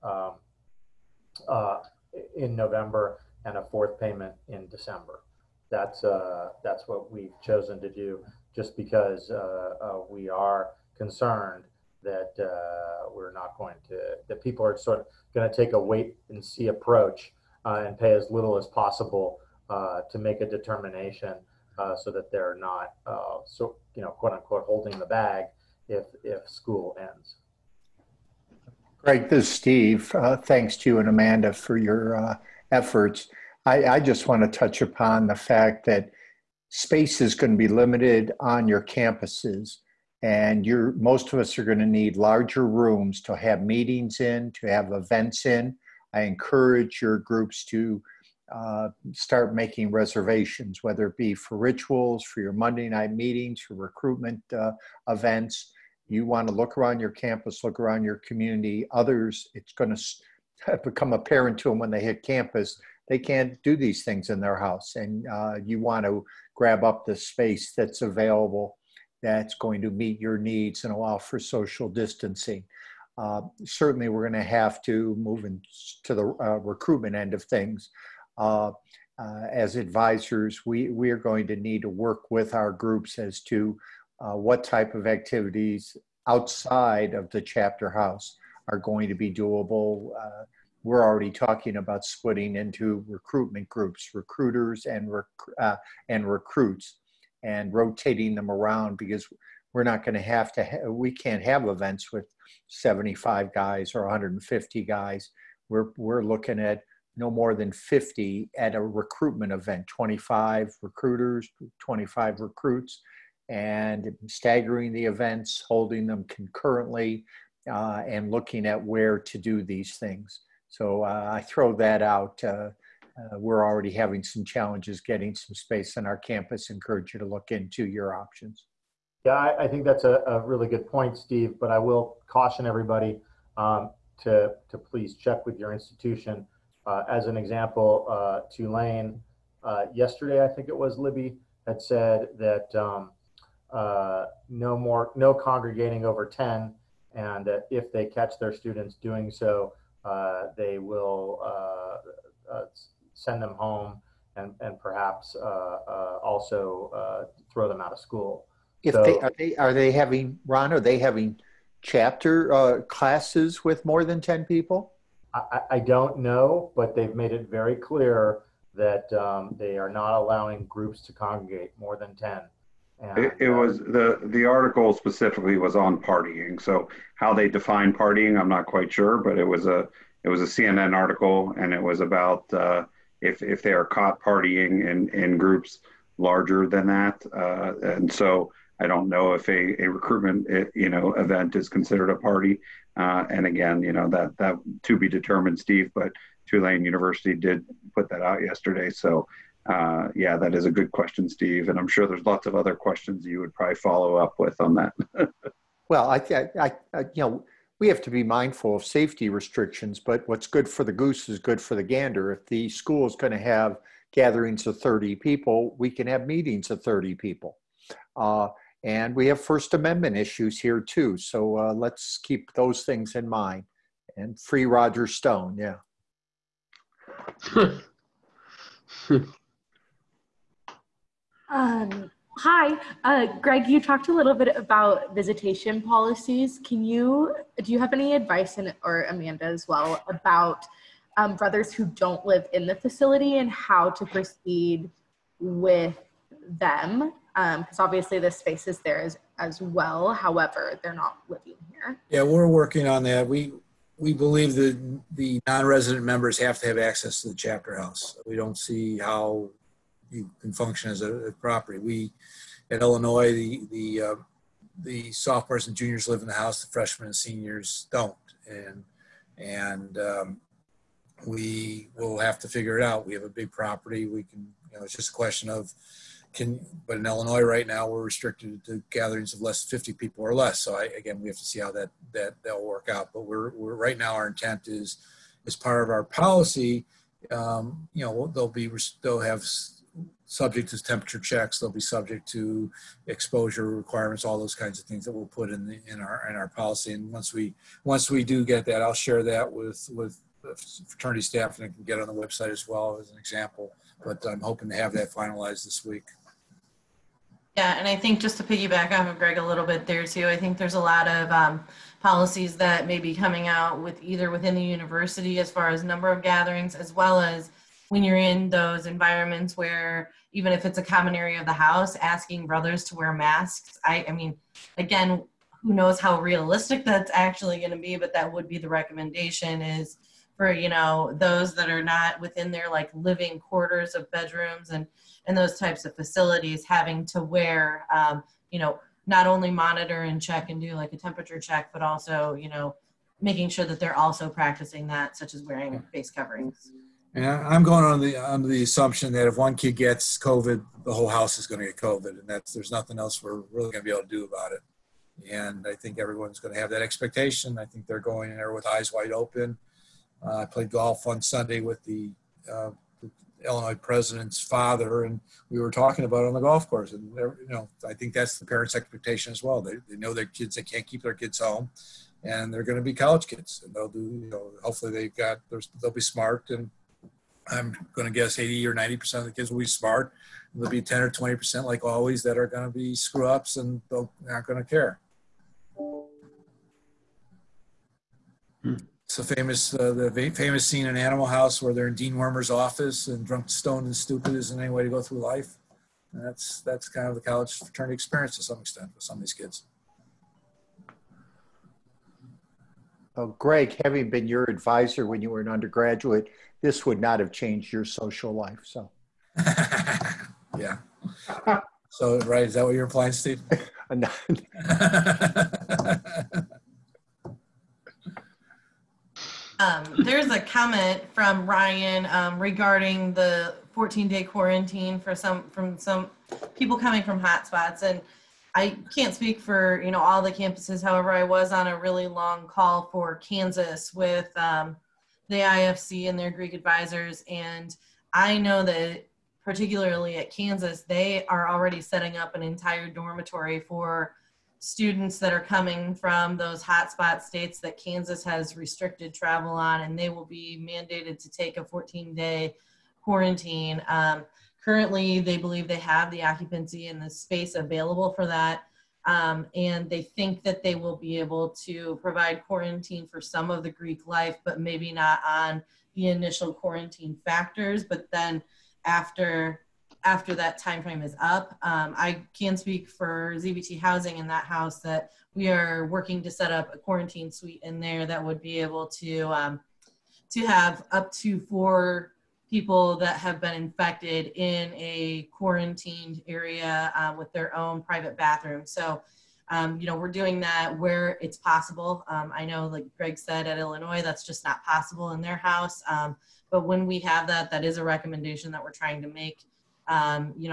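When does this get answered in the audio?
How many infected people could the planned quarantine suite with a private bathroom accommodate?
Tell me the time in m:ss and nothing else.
8:01.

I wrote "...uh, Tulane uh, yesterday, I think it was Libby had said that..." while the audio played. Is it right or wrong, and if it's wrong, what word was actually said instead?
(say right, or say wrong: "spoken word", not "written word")
right.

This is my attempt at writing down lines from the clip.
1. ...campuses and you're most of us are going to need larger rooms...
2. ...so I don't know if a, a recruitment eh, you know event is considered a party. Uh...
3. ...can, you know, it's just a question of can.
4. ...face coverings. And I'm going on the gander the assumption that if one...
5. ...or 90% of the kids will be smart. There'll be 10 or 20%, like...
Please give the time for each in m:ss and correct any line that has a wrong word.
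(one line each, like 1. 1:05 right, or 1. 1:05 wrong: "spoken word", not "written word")
1. 0:38 right
2. 3:08 right
3. 4:34 right
4. 5:45 wrong: "under", not "gander"
5. 6:18 right.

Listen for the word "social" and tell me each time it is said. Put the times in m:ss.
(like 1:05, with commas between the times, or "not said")
1:11, 6:47.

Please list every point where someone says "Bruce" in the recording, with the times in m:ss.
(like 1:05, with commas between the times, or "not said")
not said.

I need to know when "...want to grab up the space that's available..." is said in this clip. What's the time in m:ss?
1:05.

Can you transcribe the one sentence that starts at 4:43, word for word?
But we're we're right now our intent is as part of our policy.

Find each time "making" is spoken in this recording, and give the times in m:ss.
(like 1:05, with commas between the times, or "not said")
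0:49, 5:43.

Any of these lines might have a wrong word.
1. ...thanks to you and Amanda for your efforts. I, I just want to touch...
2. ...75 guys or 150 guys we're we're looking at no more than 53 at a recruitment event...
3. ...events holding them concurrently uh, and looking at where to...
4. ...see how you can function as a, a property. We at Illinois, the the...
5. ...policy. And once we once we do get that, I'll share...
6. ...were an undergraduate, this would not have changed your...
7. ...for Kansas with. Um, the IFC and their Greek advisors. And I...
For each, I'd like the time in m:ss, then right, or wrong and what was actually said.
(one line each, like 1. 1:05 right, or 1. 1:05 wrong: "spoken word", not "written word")
1. 0:30 right
2. 1:42 wrong: "50", not "53"
3. 1:55 right
4. 4:18 right
5. 4:56 right
6. 6:45 right
7. 7:12 right.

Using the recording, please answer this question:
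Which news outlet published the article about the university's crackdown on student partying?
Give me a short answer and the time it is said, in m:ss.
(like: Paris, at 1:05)
CNN, at 3:00.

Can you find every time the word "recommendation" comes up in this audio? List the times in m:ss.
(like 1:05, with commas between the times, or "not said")
5:28, 8:17.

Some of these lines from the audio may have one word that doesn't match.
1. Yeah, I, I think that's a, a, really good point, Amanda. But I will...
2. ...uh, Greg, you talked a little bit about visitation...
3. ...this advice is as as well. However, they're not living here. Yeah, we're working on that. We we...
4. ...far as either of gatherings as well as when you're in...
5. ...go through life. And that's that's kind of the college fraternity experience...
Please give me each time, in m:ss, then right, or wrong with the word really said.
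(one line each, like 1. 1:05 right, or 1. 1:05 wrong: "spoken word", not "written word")
1. 2:09 wrong: "Steve", not "Amanda"
2. 3:53 right
3. 4:08 wrong: "space", not "advice"
4. 5:15 wrong: "number", not "either"
5. 6:34 right.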